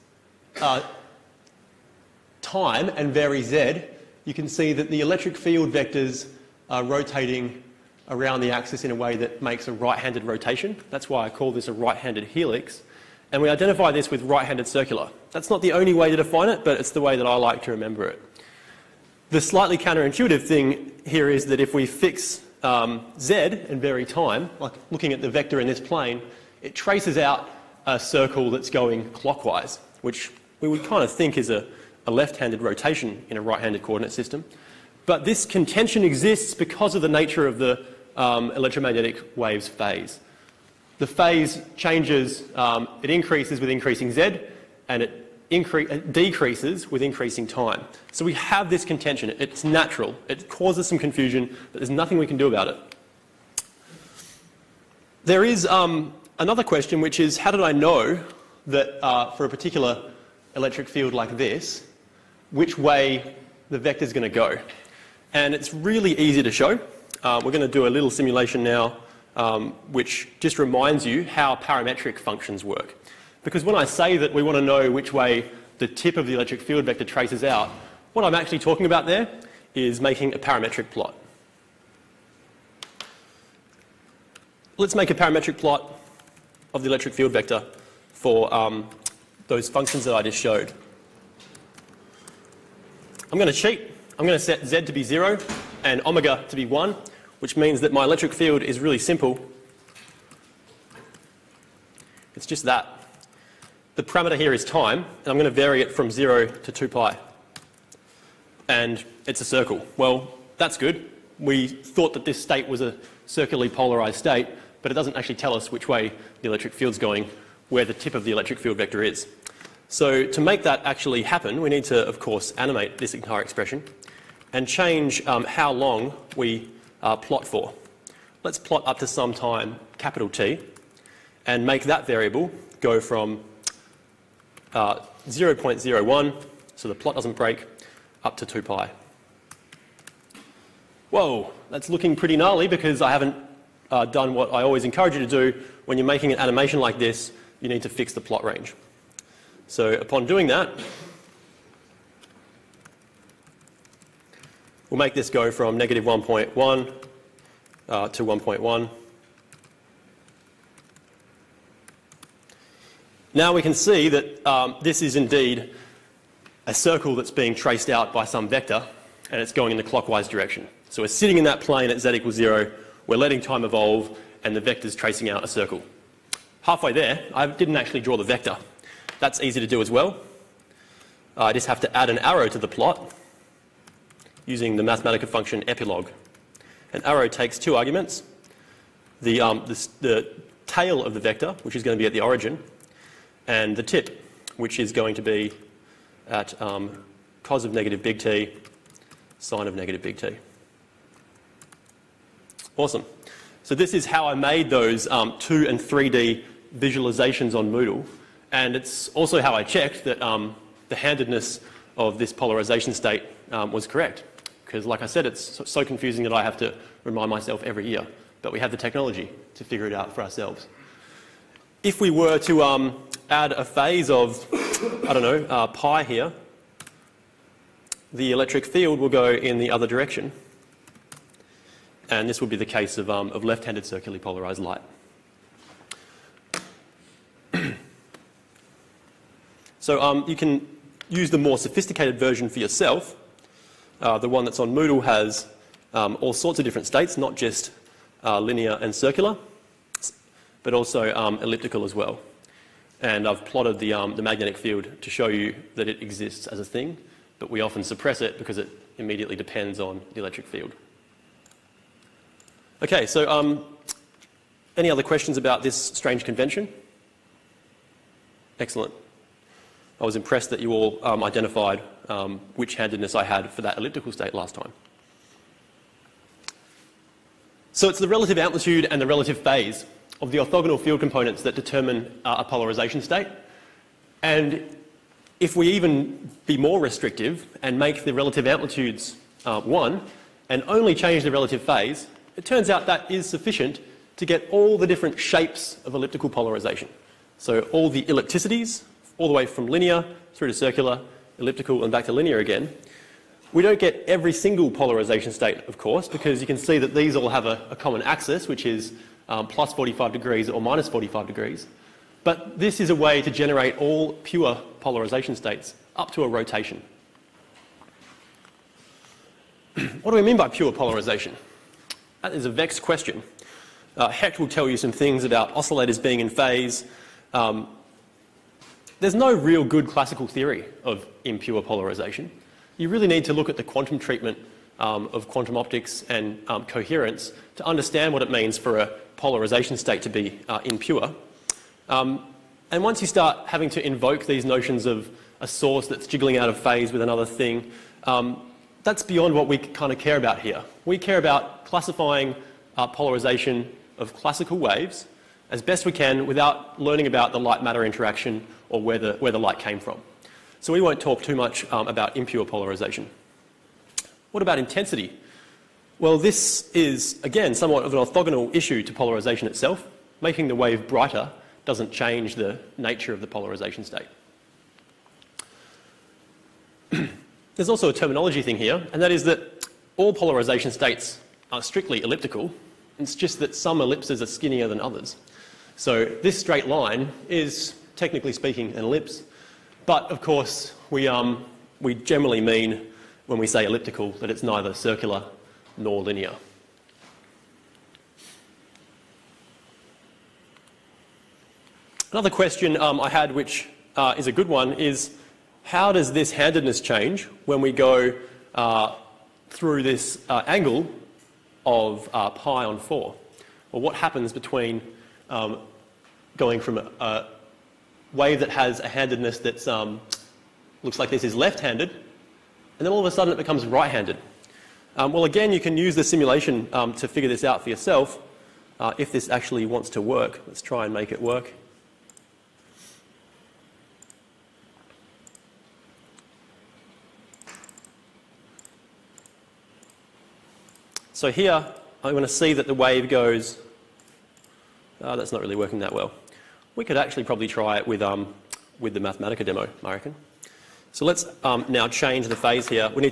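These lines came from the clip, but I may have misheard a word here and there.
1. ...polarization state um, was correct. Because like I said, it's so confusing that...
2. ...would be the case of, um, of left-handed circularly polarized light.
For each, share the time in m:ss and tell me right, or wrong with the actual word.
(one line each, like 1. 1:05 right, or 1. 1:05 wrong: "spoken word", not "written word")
1. 3:32 right
2. 3:52 right.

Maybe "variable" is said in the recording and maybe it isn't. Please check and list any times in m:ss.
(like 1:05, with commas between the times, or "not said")
2:12.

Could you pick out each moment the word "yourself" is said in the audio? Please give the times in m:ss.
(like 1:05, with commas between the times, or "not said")
4:02, 7:07.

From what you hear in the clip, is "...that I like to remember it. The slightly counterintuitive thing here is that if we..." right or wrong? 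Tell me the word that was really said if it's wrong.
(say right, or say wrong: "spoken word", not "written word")
right.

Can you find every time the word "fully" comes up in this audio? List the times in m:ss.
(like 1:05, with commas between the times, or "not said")
not said.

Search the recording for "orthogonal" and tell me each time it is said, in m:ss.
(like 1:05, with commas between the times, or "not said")
4:40, 6:07.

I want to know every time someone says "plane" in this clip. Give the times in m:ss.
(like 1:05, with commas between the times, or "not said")
0:25, 2:51.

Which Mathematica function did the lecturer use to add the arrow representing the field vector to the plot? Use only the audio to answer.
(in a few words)
Epilog.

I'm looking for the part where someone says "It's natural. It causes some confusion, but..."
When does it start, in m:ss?
0:49.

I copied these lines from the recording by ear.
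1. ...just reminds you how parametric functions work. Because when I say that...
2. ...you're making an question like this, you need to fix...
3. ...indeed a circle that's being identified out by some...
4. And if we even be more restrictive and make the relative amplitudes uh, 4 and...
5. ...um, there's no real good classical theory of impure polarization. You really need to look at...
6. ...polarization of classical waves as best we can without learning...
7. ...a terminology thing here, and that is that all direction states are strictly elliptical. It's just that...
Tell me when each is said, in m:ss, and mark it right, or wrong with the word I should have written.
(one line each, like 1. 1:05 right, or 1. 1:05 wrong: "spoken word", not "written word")
1. 1:10 right
2. 2:25 wrong: "animation", not "question"
3. 2:45 wrong: "traced", not "identified"
4. 4:44 wrong: "1", not "4"
5. 5:27 right
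6. 5:52 right
7. 6:17 wrong: "polarization", not "direction".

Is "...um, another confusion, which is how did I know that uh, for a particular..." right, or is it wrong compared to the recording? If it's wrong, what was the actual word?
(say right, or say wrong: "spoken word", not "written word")
wrong: "question", not "confusion".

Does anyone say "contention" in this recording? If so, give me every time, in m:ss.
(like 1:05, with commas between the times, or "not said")
0:35, 0:48.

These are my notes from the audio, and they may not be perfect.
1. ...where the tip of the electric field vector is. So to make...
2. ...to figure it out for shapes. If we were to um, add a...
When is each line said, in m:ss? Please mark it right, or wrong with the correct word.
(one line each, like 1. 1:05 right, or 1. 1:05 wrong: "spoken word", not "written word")
1. 1:57 right
2. 3:39 wrong: "ourselves", not "shapes".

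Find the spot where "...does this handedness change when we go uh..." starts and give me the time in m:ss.
6:45.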